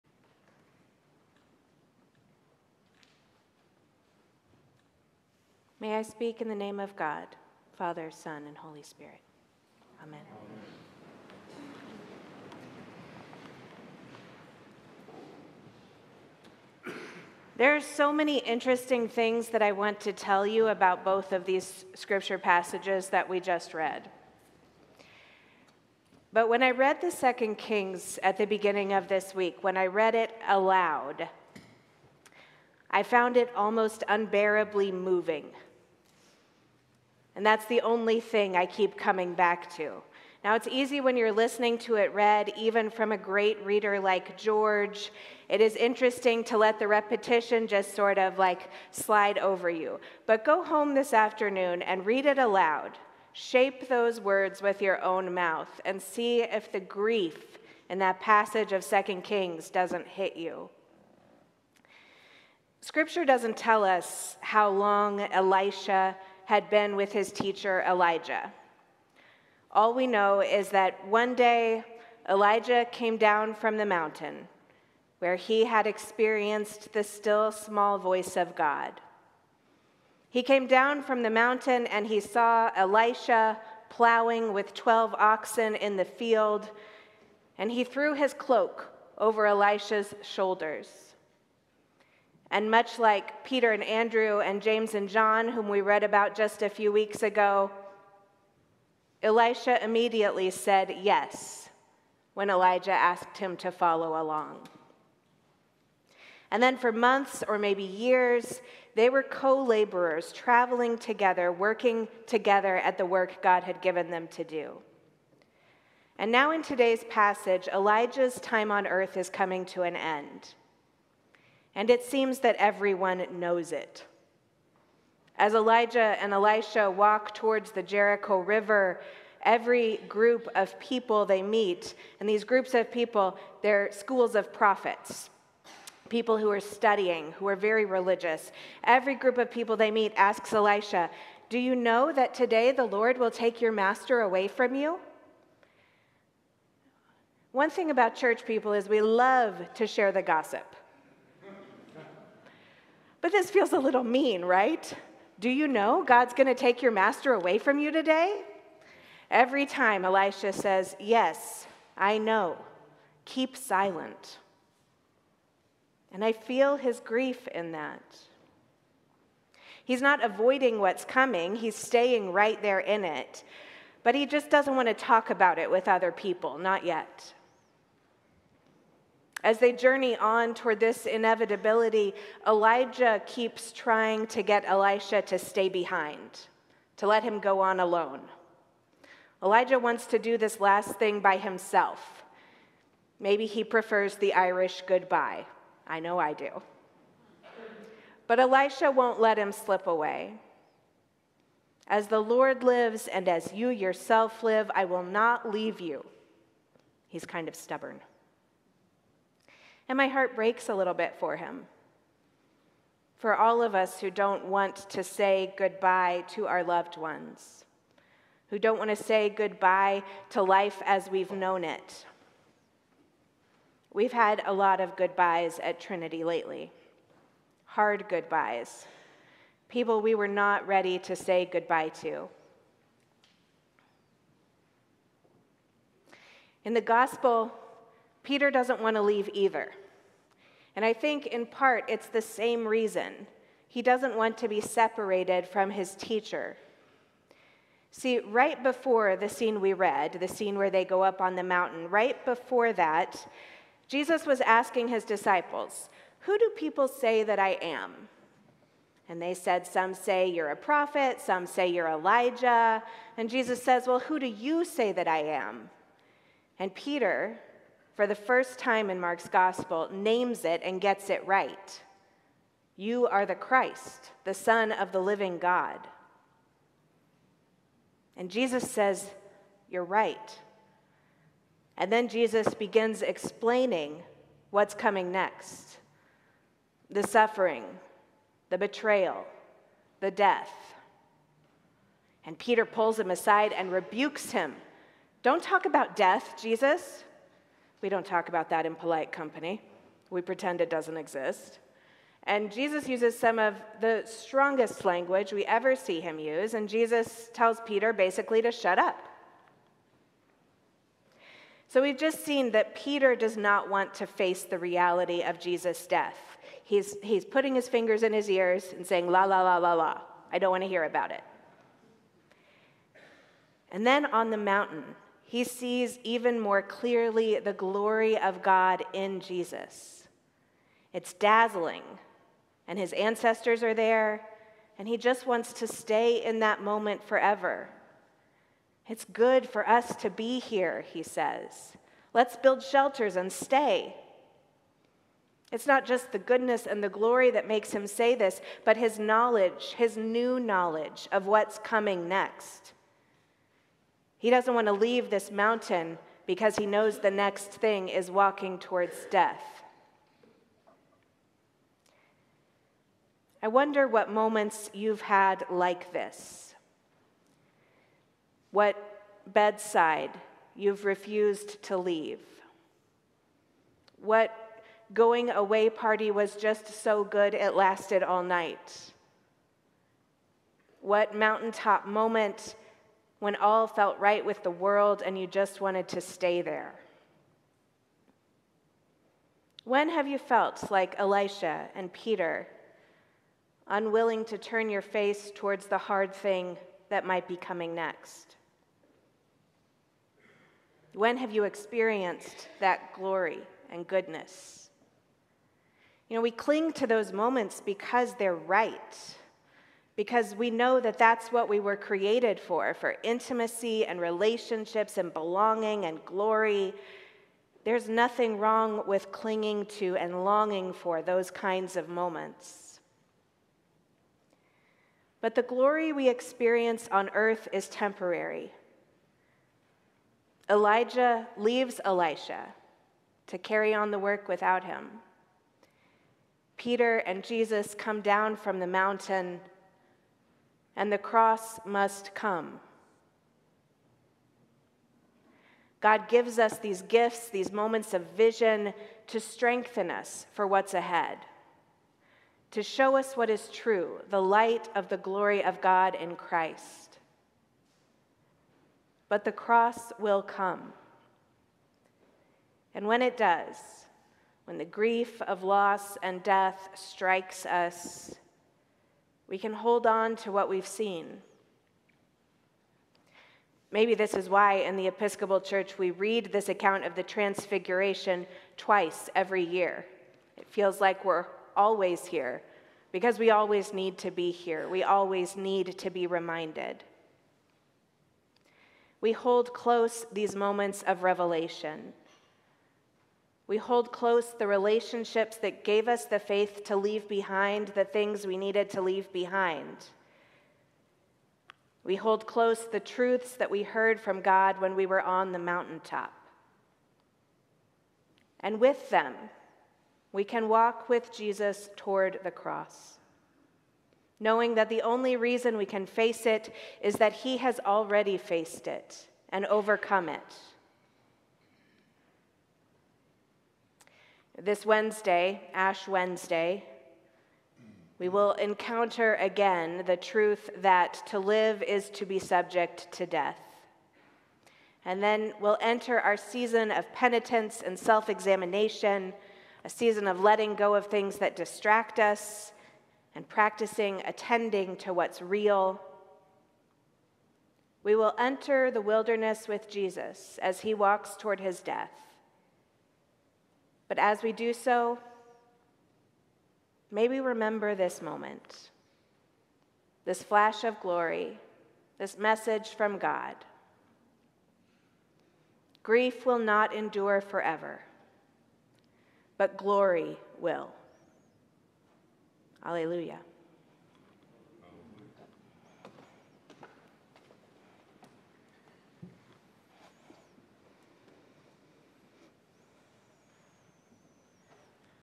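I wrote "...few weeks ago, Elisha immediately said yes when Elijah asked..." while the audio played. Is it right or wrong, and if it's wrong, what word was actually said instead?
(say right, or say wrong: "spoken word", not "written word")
right.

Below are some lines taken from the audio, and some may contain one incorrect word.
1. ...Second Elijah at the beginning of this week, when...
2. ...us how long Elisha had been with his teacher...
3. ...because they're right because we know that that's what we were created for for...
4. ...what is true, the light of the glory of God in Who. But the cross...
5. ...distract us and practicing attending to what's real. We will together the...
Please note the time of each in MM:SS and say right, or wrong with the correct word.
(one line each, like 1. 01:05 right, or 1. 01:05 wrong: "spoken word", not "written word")
1. 00:27 wrong: "Kings", not "Elijah"
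2. 01:03 right
3. 06:47 right
4. 07:33 wrong: "Christ", not "Who"
5. 09:01 wrong: "enter", not "together".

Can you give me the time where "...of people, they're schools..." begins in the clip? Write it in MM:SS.
02:12.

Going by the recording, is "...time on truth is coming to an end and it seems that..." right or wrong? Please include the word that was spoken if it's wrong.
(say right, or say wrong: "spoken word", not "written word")
wrong: "earth", not "truth".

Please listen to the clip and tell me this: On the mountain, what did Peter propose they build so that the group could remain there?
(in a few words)
Shelters.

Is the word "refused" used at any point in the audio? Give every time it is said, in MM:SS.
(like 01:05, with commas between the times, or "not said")
06:10.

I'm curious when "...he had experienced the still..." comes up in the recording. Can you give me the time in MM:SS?
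01:15.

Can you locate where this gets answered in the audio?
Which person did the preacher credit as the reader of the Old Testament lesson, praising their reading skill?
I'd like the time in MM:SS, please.
00:44.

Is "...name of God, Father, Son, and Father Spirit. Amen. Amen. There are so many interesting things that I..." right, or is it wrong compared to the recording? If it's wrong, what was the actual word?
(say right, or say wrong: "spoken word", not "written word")
wrong: "Holy", not "Father".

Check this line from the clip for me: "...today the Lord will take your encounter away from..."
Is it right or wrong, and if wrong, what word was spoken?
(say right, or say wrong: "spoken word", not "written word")
wrong: "master", not "encounter".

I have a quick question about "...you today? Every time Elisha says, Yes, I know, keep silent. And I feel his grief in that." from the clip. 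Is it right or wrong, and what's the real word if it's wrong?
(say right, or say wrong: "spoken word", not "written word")
right.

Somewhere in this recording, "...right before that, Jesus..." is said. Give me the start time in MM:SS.
04:11.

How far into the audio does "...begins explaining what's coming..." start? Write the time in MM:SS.
04:42.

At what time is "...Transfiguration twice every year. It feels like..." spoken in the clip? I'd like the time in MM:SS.
07:57.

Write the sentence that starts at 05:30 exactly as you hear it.
It's dazzling, and his ancestors are there, and he just wants to stay in that moment forever.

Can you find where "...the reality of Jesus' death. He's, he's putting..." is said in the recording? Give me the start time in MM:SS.
05:14.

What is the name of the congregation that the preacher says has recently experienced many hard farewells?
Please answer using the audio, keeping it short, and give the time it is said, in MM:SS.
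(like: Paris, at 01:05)
Trinity, at 03:45.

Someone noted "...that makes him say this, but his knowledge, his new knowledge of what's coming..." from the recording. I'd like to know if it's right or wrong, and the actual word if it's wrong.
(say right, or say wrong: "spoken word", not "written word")
right.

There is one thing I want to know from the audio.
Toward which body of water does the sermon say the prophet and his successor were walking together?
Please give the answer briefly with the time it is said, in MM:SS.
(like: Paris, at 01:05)
Jericho River, at 02:07.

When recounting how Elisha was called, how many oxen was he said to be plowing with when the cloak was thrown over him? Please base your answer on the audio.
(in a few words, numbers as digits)
12.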